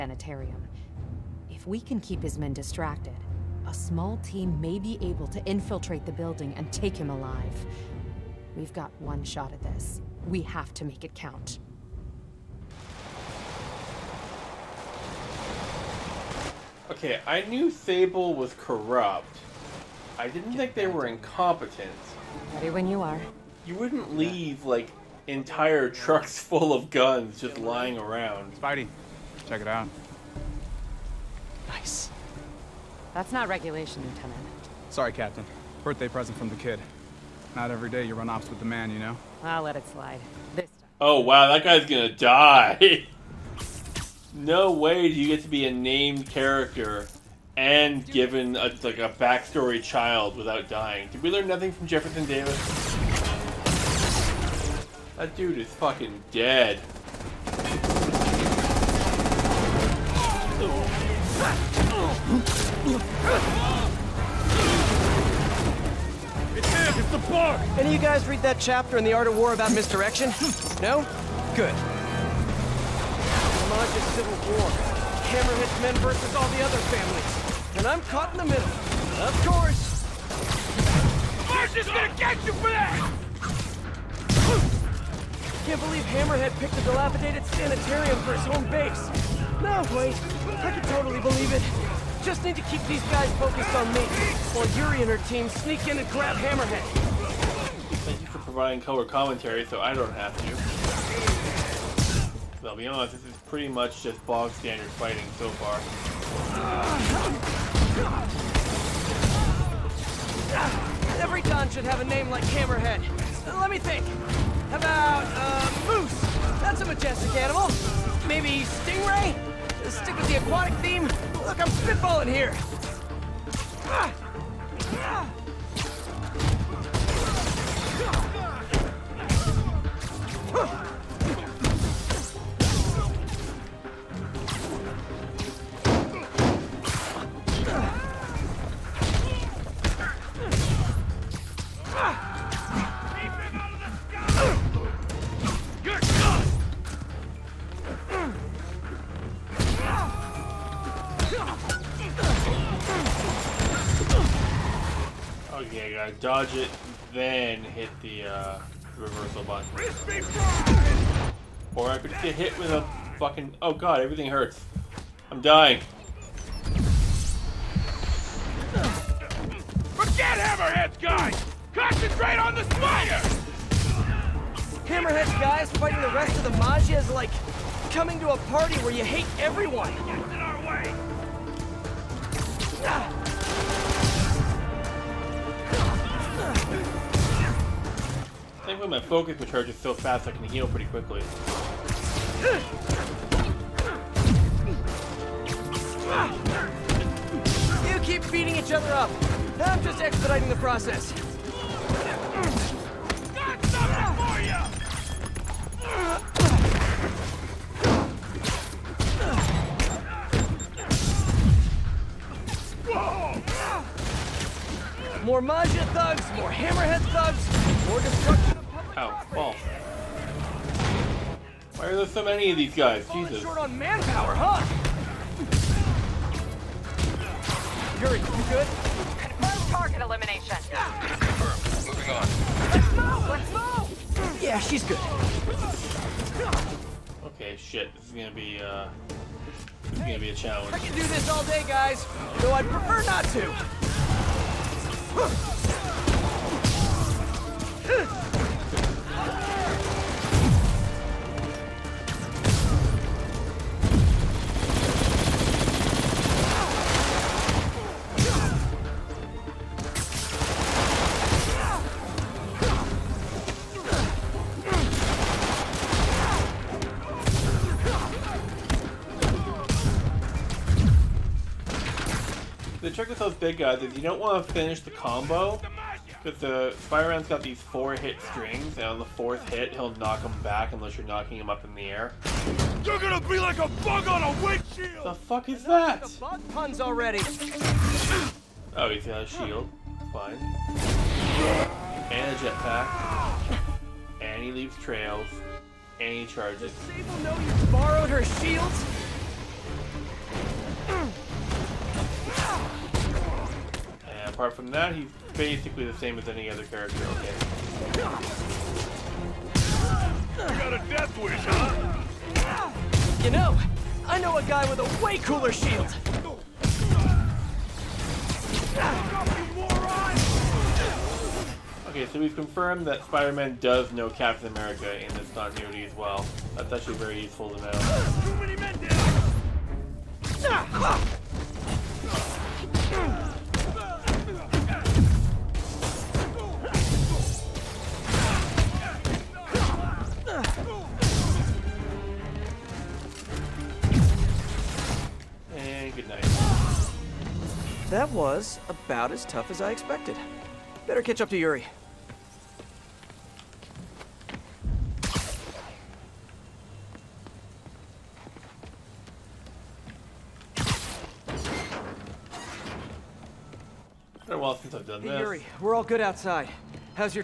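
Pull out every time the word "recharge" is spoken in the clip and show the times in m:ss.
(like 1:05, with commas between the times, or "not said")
3:09.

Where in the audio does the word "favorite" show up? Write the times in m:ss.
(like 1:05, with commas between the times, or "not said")
not said.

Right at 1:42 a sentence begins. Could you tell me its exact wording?
I'll be honest, this is pretty much just bog standard fighting so far.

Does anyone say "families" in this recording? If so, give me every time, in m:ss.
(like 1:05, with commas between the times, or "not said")
1:16.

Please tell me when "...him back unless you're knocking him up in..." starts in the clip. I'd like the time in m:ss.
4:40.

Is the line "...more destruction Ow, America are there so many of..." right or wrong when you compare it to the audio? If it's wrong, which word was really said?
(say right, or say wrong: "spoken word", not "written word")
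wrong: "Why", not "America".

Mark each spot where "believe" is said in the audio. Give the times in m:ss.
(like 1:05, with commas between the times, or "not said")
1:25, 1:31.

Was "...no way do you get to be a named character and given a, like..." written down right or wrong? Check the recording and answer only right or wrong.
right.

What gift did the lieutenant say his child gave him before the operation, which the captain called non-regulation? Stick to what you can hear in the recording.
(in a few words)
Birthday present.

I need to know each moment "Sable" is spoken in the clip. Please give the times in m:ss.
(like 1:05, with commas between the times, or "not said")
0:17, 4:56.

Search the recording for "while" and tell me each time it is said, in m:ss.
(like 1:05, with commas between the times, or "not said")
1:34, 6:04.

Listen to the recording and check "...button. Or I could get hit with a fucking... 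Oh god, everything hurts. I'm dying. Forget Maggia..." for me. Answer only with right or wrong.
wrong.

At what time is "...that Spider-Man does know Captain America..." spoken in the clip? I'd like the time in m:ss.
5:22.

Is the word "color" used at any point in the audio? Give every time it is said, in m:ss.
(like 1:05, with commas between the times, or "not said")
1:38.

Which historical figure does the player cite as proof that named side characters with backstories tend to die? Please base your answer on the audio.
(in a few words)
Jefferson Davis.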